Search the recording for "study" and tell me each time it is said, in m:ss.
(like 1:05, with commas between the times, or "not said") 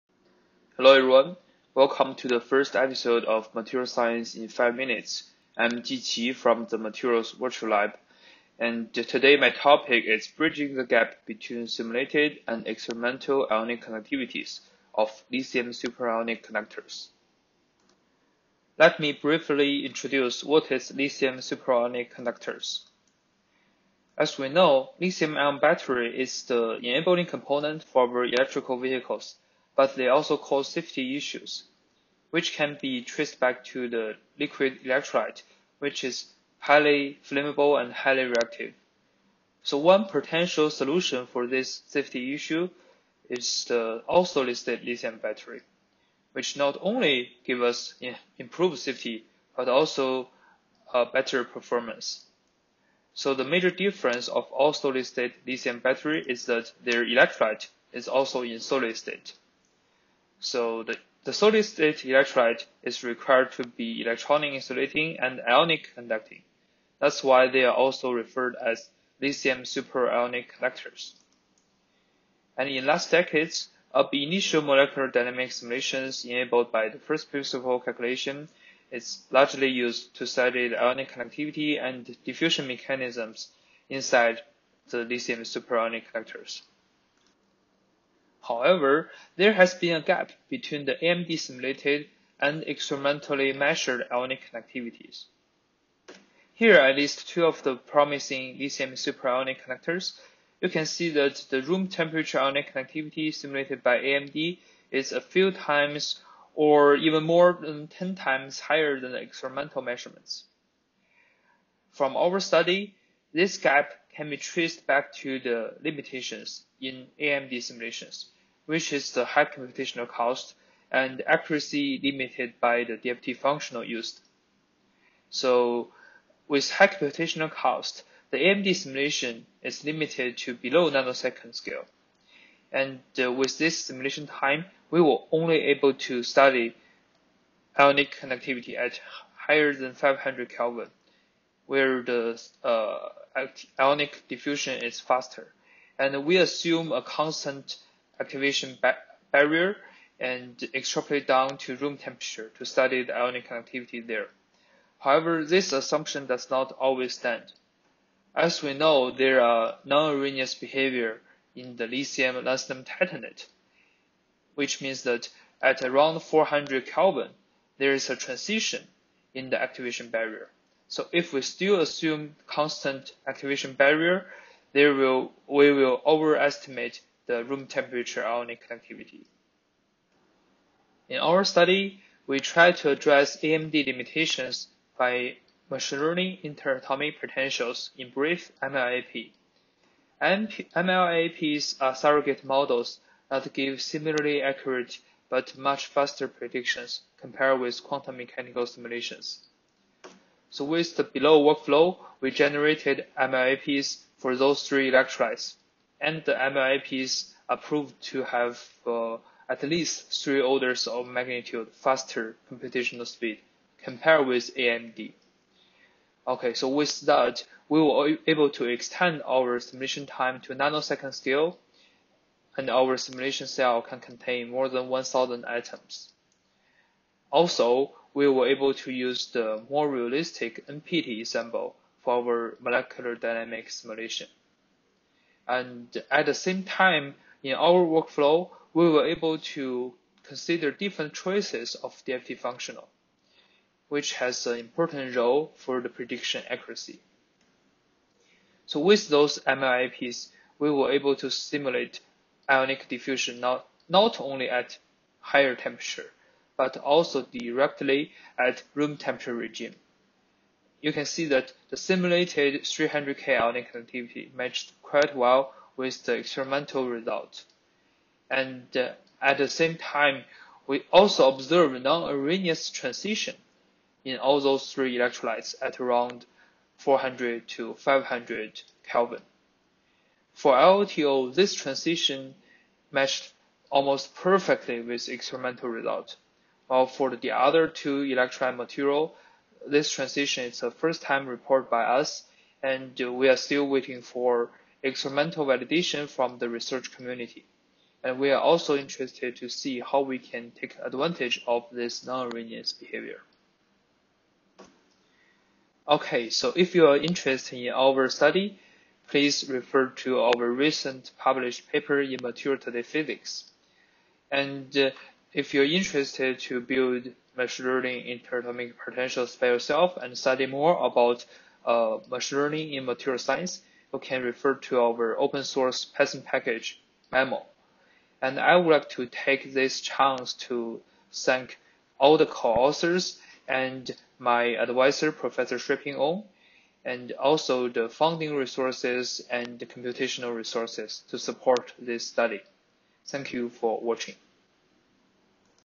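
1:20, 1:52, 2:16, 2:32, 3:01, 5:08, 5:20, 5:42.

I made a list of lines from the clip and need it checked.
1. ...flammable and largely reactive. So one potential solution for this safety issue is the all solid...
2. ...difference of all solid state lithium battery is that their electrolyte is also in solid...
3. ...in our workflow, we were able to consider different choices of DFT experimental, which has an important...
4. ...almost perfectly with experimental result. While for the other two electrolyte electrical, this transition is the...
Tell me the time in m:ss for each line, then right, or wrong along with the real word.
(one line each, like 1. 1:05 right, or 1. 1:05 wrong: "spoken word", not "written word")
1. 0:37 wrong: "highly", not "largely"
2. 0:53 right
3. 3:57 wrong: "functional", not "experimental"
4. 4:43 wrong: "material", not "electrical".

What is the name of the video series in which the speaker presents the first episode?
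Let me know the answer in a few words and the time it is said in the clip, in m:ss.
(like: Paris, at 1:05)
Material Science in 5 Minutes, at 0:03.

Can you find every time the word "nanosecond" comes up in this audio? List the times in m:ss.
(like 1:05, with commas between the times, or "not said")
2:10, 3:40.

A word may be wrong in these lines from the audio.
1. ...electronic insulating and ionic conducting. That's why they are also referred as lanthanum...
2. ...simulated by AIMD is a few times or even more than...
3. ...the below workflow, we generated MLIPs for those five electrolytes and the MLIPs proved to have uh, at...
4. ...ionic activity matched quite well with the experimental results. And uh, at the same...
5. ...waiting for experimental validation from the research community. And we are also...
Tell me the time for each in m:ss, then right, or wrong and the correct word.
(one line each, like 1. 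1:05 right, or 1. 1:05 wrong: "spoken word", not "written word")
1. 1:04 wrong: "lithium", not "lanthanum"
2. 1:43 right
3. 3:20 wrong: "three", not "five"
4. 4:23 right
5. 4:53 right.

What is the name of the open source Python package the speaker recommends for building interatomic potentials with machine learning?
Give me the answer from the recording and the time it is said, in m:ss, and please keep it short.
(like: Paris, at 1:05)
maml, at 5:27.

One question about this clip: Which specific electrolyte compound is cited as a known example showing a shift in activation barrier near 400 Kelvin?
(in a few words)
lithium lanthanum titanate.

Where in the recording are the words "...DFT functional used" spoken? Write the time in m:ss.
2:02.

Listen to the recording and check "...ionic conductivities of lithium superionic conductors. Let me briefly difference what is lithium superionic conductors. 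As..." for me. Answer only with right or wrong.
wrong.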